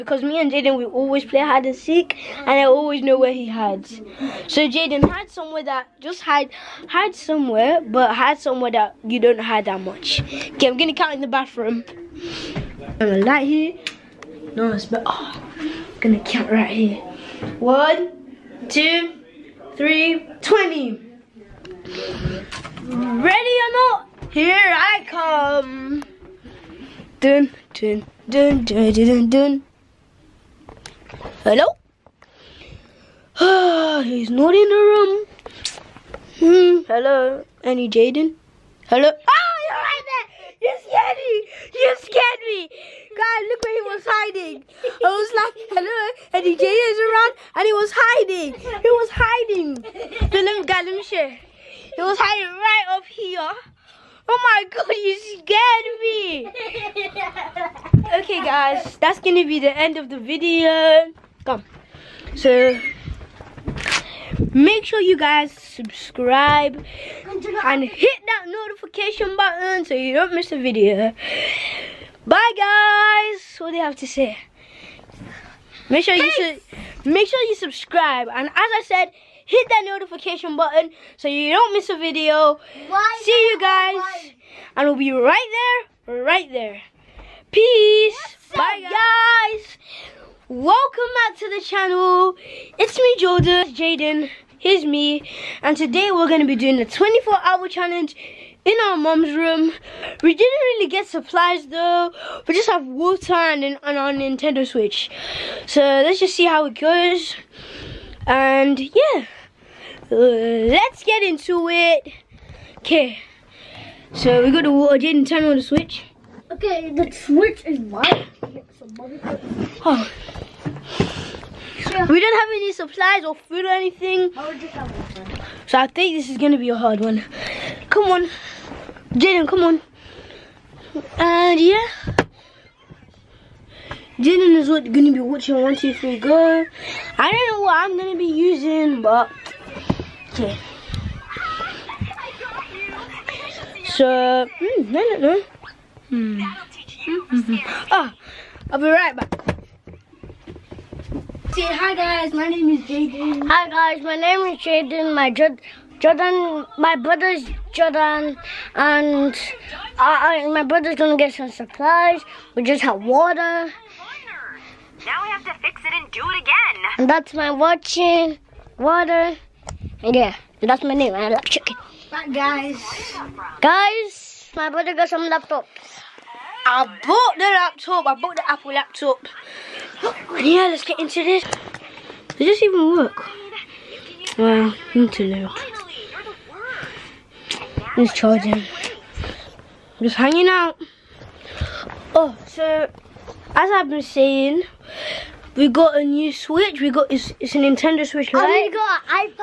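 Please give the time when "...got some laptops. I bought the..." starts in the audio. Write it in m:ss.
2:54.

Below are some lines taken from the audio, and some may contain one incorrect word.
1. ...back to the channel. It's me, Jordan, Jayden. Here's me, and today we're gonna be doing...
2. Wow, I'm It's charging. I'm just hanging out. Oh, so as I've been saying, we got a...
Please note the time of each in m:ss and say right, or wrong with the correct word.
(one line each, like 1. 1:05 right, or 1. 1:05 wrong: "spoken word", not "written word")
1. 1:31 right
2. 3:04 right.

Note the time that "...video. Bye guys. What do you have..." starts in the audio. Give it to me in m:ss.
1:10.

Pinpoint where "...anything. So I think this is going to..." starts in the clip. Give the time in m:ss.
2:03.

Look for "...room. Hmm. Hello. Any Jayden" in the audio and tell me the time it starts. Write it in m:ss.
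0:34.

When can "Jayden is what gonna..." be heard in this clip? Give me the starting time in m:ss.
2:14.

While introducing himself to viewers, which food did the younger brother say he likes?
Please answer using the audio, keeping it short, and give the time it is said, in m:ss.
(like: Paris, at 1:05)
Chicken, at 2:51.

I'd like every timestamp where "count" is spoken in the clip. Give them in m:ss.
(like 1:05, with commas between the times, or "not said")
0:10, 0:16.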